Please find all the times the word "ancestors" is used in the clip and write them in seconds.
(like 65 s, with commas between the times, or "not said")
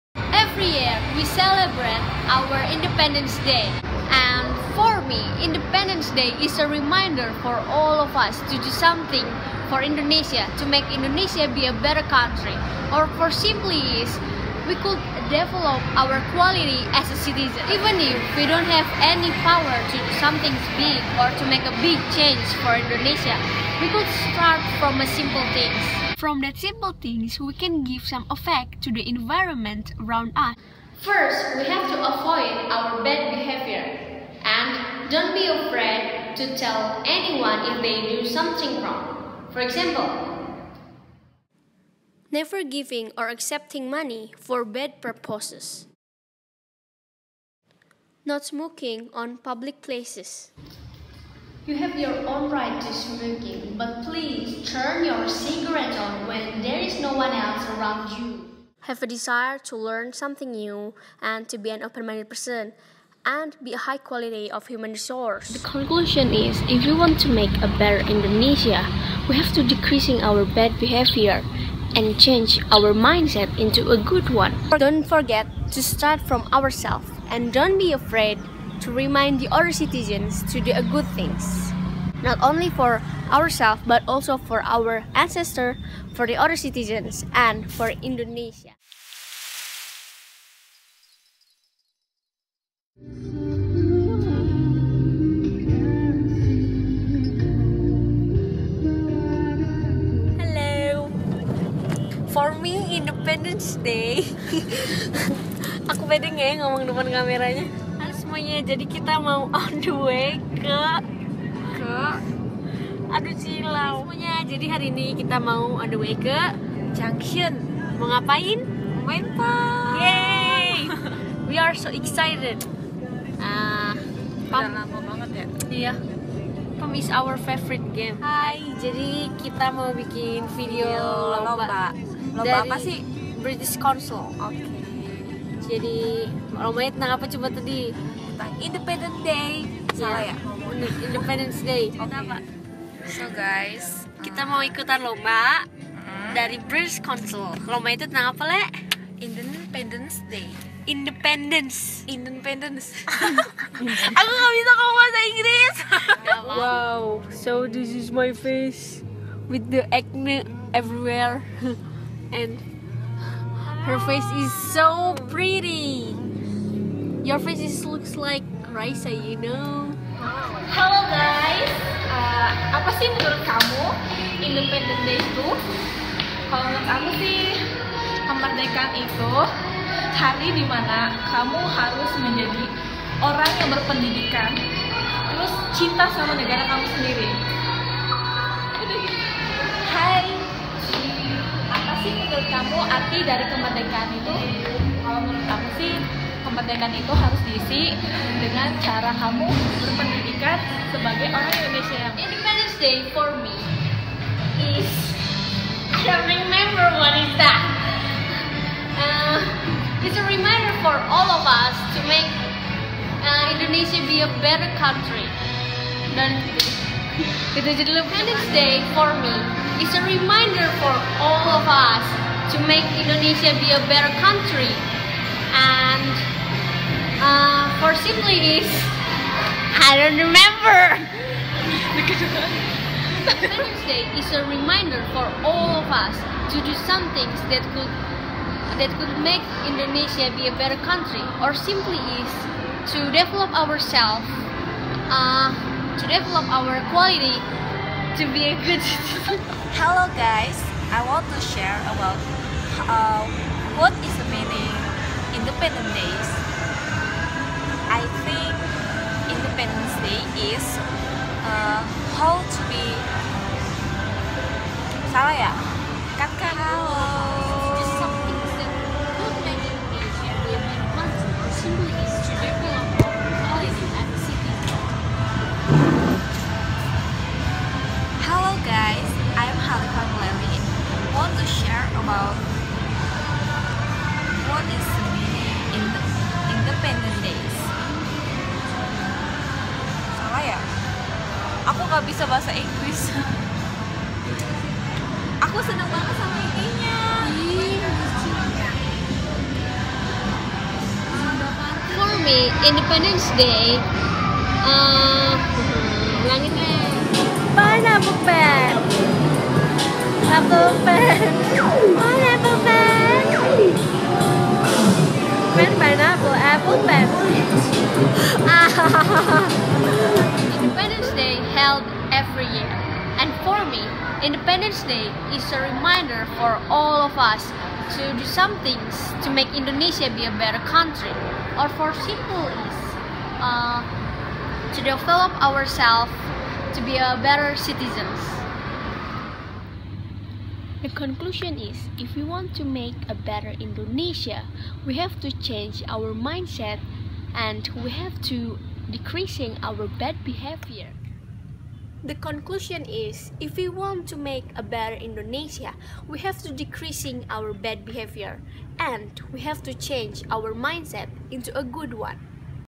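85 s.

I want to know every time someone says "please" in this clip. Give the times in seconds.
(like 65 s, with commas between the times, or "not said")
54 s.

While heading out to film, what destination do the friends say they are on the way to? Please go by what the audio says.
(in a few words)
Junction.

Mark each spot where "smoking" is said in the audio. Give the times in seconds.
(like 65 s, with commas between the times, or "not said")
48 s, 52 s.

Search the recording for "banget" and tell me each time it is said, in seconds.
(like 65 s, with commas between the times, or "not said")
125 s, 295 s.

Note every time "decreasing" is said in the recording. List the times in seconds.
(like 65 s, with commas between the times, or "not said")
69 s, 348 s, 356 s.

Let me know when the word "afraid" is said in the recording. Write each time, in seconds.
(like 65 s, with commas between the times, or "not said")
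35 s, 77 s.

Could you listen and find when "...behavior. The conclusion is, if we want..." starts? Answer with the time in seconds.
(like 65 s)
350 s.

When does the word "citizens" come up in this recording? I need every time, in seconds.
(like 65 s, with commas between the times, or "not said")
17 s, 79 s, 86 s, 248 s, 337 s.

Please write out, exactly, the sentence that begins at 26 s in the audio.
From that simple things, we can give some effect to the environment around us.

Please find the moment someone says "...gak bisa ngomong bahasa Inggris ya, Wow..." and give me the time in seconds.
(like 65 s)
154 s.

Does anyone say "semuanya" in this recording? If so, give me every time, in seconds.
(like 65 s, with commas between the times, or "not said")
108 s, 114 s.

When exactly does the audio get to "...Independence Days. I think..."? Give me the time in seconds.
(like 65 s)
255 s.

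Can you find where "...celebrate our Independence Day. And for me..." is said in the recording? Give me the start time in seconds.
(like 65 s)
1 s.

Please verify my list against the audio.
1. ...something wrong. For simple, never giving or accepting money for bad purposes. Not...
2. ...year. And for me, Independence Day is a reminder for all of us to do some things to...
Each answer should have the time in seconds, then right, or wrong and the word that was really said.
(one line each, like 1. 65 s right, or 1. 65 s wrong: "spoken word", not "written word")
1. 38 s wrong: "example", not "simple"
2. 322 s right.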